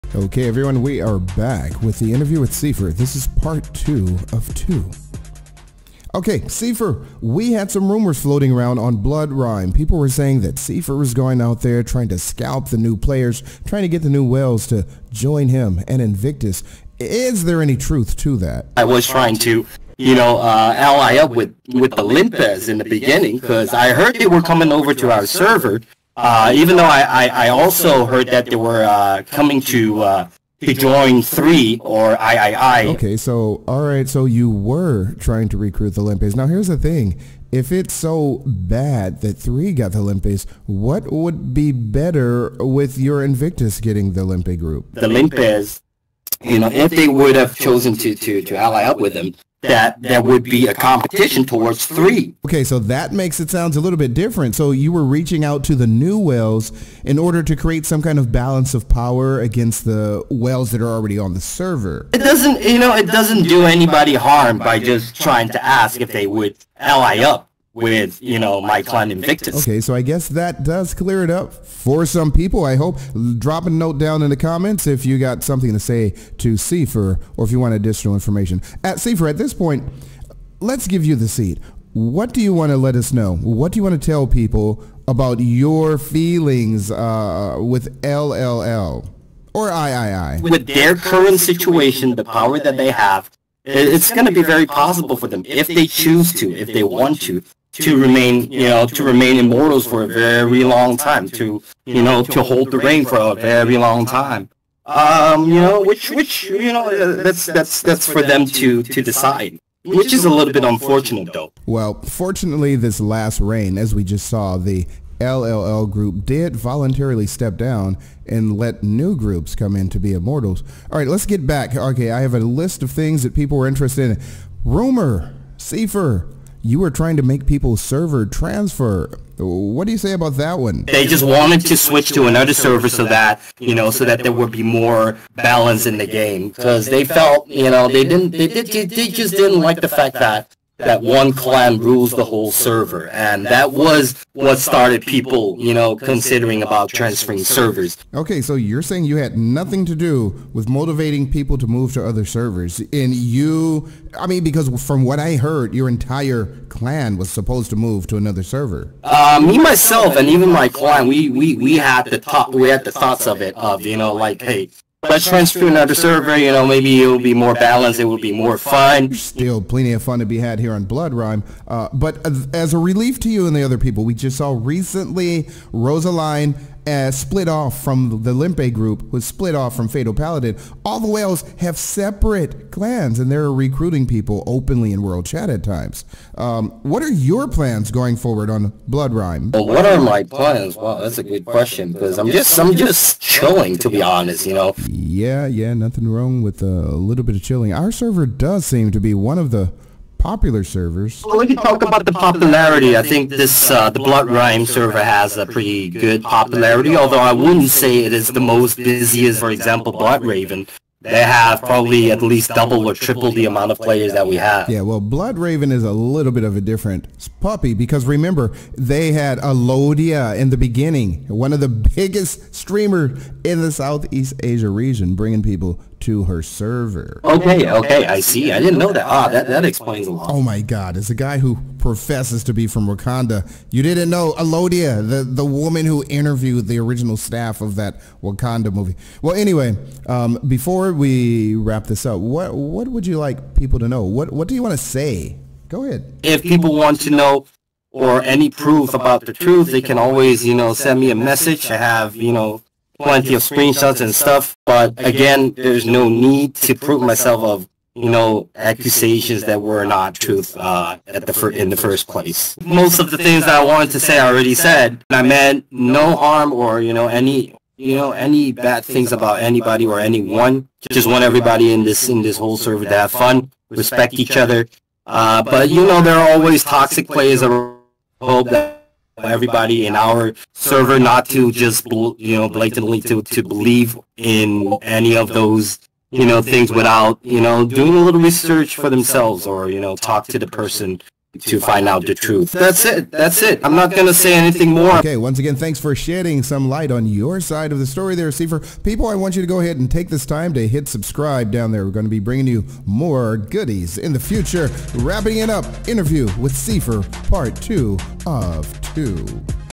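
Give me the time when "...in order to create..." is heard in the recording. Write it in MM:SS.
00:57.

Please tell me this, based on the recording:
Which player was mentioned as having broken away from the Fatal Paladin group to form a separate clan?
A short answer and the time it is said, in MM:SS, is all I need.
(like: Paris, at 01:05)
Rosaline, at 02:55.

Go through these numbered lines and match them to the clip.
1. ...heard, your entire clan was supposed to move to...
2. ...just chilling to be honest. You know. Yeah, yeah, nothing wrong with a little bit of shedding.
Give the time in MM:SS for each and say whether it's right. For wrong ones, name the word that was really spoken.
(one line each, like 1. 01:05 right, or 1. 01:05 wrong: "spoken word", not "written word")
1. 02:35 right
2. 03:12 wrong: "chilling", not "shedding".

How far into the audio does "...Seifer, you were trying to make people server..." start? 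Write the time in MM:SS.
02:05.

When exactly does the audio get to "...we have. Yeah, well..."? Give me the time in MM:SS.
03:34.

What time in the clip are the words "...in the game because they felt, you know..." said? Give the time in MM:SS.
02:15.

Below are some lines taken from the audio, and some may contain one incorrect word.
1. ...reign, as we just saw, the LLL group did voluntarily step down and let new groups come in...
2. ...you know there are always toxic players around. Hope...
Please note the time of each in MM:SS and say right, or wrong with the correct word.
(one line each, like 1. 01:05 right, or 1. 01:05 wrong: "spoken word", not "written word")
1. 01:53 right
2. 04:35 right.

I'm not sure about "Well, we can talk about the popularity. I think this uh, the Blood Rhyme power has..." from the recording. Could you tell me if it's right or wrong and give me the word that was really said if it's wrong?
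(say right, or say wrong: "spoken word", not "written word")
wrong: "server", not "power".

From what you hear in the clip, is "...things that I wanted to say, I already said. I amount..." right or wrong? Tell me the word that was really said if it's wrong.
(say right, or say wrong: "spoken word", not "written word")
wrong: "meant", not "amount".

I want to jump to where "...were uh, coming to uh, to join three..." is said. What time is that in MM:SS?
00:28.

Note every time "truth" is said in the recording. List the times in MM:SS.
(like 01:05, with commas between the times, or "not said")
00:17, 04:09, 04:20, 04:52.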